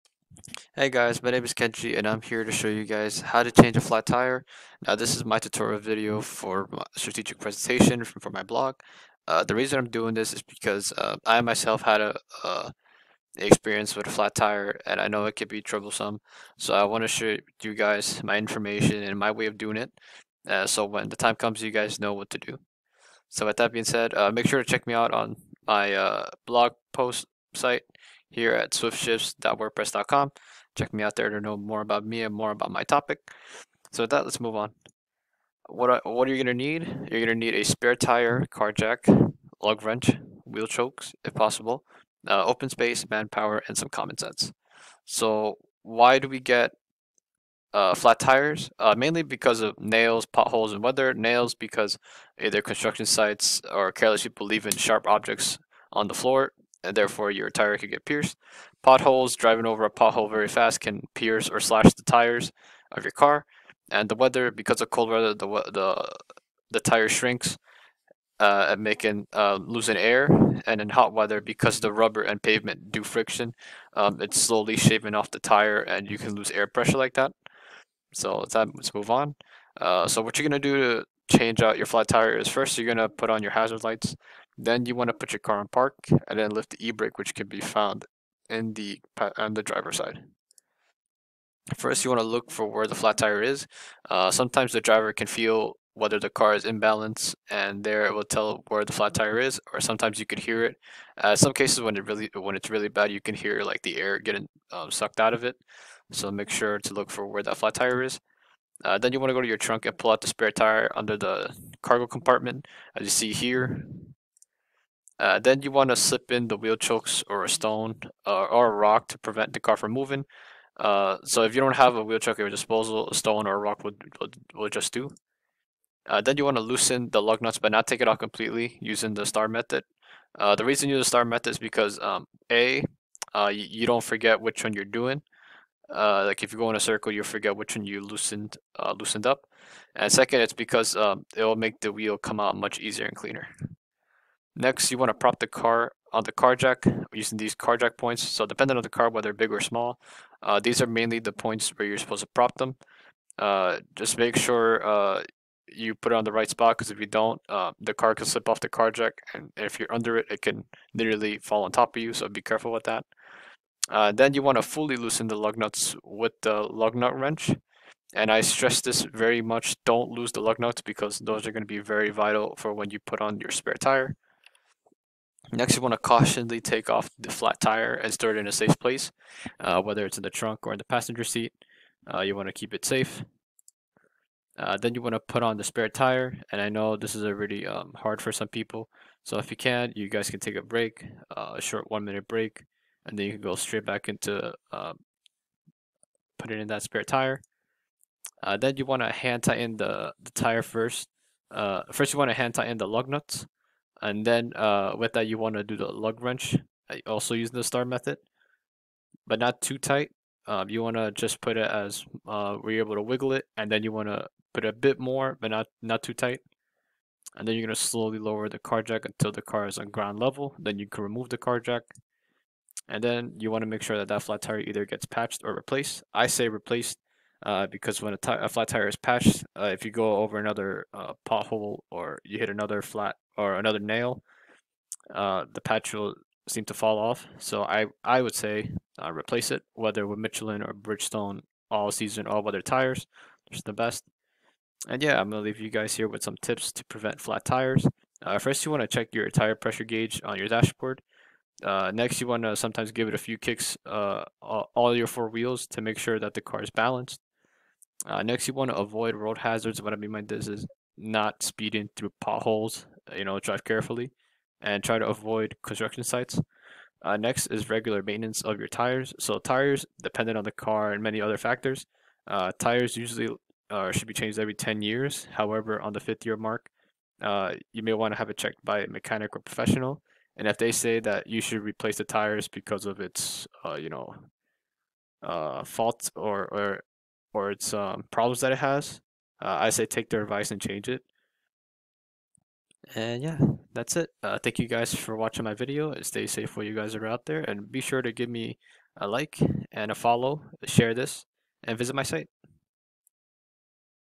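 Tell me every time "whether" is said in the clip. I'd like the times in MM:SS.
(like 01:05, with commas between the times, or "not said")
01:35, 02:29, 02:59, 03:59.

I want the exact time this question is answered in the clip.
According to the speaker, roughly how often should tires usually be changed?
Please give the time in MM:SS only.
04:34.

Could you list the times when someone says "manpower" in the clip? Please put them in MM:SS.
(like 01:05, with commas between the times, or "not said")
00:43.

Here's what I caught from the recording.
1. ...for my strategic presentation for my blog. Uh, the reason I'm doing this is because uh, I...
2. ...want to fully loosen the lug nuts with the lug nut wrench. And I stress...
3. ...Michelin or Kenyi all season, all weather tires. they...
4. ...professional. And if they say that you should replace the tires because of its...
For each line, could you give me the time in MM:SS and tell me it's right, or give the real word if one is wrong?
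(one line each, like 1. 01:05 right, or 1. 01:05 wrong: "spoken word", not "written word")
1. 00:06 right
2. 02:44 right
3. 04:00 wrong: "Bridgestone", not "Kenyi"
4. 04:39 right.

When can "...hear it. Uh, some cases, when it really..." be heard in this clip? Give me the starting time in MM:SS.
01:40.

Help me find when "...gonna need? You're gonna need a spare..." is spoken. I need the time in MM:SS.
00:36.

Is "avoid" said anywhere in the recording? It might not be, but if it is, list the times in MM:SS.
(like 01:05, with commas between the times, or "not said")
04:18, 04:25.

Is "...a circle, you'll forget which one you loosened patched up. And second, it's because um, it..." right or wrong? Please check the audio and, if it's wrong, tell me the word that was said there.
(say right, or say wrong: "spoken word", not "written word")
wrong: "loosened", not "patched".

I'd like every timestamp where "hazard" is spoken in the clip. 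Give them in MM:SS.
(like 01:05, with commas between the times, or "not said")
01:23, 04:19.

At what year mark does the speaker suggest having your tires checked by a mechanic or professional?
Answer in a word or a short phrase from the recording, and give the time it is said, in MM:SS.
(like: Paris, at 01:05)
fifth year, at 04:35.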